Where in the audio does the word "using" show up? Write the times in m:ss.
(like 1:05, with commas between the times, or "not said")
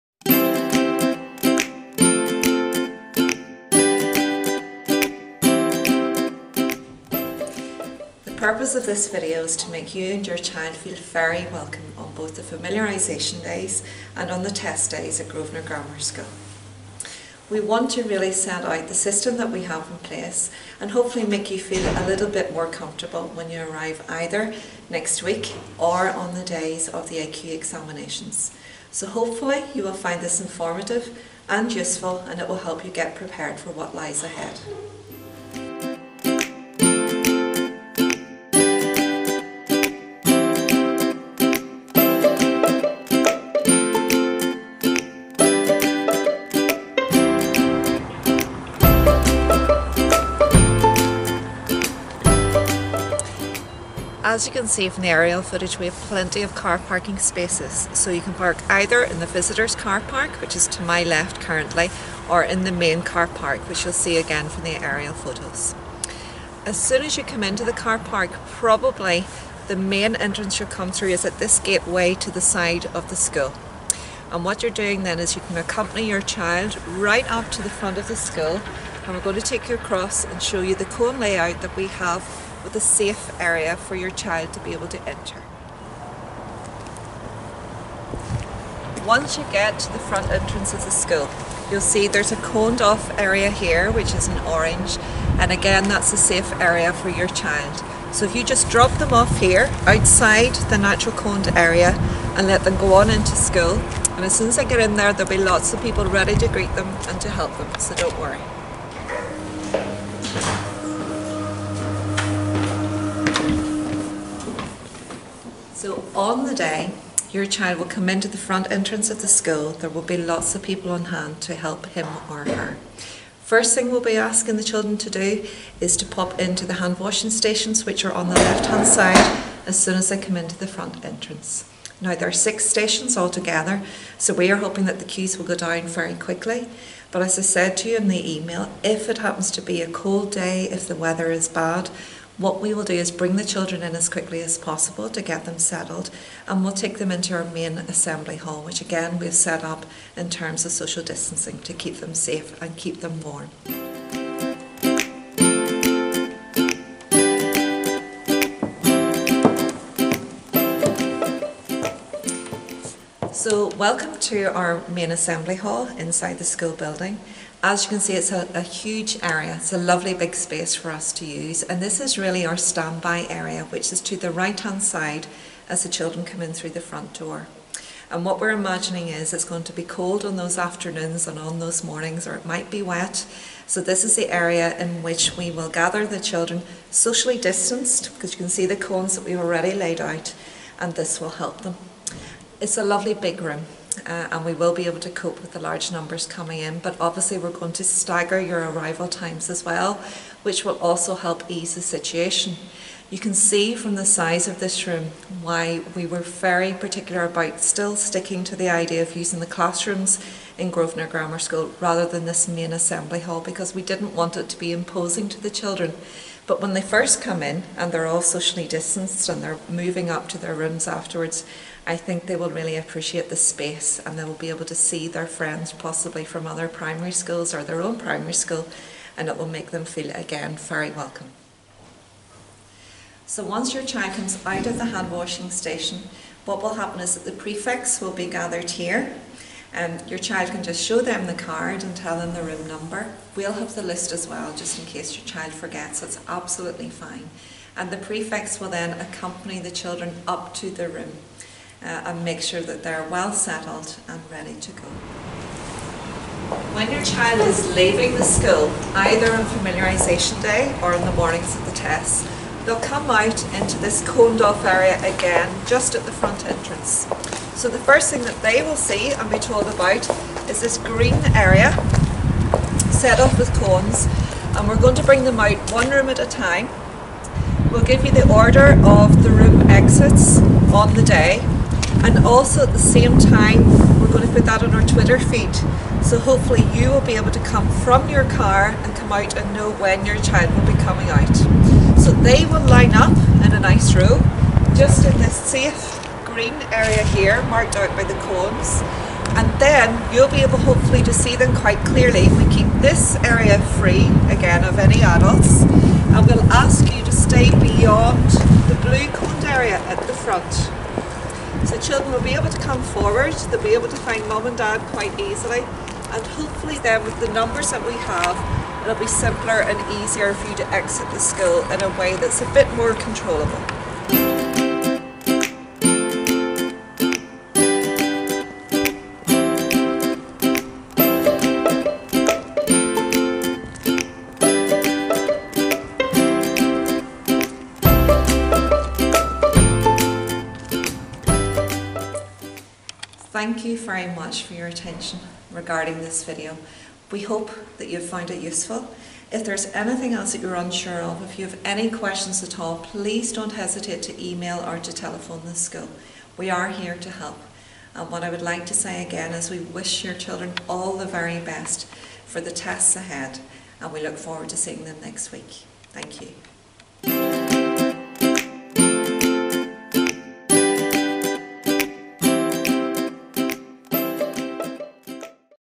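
3:29.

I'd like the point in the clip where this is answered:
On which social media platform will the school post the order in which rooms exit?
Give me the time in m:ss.
4:44.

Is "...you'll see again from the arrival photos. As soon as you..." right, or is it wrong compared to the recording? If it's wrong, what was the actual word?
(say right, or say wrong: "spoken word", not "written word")
wrong: "aerial", not "arrival".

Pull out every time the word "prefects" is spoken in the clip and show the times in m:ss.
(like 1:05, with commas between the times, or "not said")
3:57, 4:07.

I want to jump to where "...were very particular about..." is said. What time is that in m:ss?
3:26.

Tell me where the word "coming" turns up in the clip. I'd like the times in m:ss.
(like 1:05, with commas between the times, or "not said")
3:16, 4:50.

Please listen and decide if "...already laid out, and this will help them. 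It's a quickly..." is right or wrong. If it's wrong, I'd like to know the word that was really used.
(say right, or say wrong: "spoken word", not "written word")
wrong: "lovely", not "quickly".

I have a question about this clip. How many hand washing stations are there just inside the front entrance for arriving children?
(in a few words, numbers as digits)
6.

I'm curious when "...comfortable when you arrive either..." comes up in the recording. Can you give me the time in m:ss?
0:22.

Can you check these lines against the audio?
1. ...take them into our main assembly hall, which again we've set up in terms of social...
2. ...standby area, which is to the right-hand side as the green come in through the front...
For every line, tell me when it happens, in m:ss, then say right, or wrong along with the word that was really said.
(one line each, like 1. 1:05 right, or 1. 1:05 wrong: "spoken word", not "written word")
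1. 2:26 right
2. 2:52 wrong: "children", not "green".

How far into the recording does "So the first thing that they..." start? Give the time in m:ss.
4:27.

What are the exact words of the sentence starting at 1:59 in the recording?
There will be lots of people on hand to help him or her.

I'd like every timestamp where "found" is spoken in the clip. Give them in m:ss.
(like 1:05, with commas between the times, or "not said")
5:48.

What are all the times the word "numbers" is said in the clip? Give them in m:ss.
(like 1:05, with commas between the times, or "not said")
3:15, 4:02, 5:17.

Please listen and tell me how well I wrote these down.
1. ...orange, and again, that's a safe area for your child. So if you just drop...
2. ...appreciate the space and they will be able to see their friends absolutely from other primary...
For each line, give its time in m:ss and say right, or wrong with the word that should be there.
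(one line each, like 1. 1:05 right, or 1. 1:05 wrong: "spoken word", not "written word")
1. 1:34 right
2. 3:42 wrong: "possibly", not "absolutely".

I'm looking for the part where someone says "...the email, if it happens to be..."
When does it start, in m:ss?
2:18.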